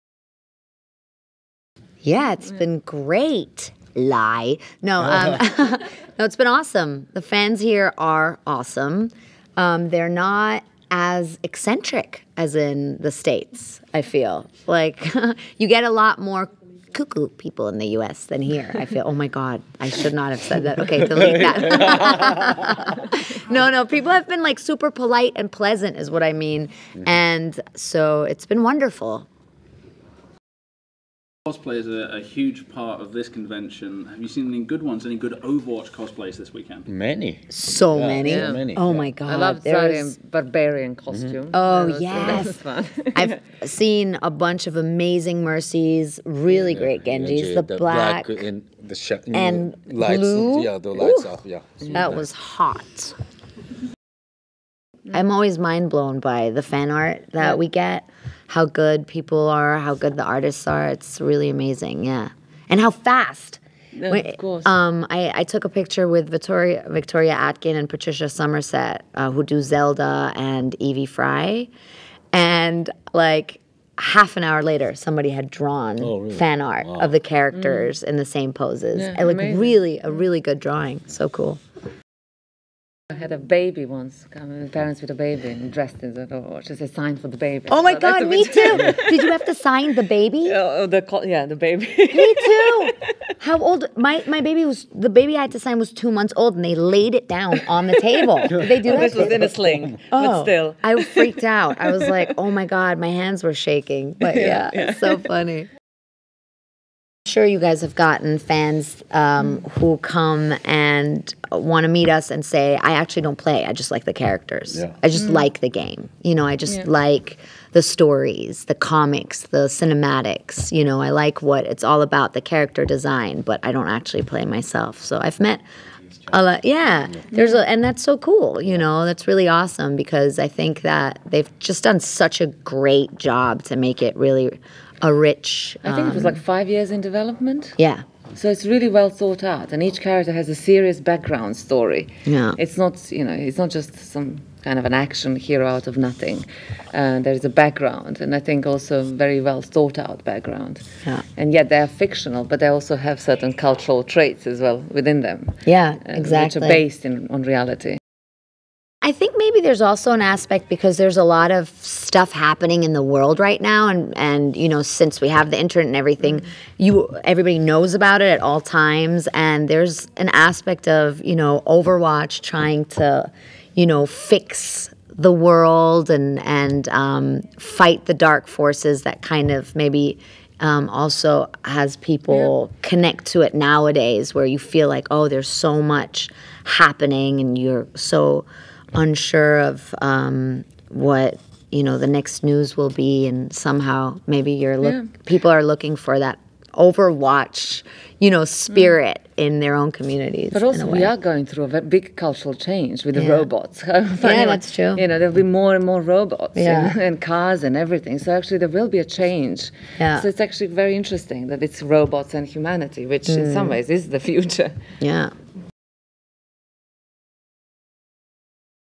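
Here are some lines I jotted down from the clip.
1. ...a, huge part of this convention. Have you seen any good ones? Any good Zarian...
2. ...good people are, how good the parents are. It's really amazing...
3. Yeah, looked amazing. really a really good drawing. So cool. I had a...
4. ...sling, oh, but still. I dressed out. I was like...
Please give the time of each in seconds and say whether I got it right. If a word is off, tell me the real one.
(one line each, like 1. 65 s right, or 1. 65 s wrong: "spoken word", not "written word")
1. 32 s wrong: "Overwatch", not "Zarian"
2. 58 s wrong: "artists", not "parents"
3. 78 s right
4. 99 s wrong: "freaked", not "dressed".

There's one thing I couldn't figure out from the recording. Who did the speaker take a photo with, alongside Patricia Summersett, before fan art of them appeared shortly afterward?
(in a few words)
Victoria Atkin.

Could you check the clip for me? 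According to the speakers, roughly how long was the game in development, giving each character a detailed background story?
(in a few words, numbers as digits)
5 years.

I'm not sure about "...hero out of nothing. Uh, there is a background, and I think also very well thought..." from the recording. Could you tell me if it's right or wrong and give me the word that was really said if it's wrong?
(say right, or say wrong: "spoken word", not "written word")
right.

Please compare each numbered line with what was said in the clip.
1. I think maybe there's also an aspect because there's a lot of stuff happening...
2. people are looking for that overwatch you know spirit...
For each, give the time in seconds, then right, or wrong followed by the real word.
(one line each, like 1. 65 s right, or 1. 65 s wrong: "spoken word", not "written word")
1. 159 s right
2. 195 s right.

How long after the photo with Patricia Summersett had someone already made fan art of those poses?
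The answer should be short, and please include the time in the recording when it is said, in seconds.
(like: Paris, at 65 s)
half an hour, at 73 s.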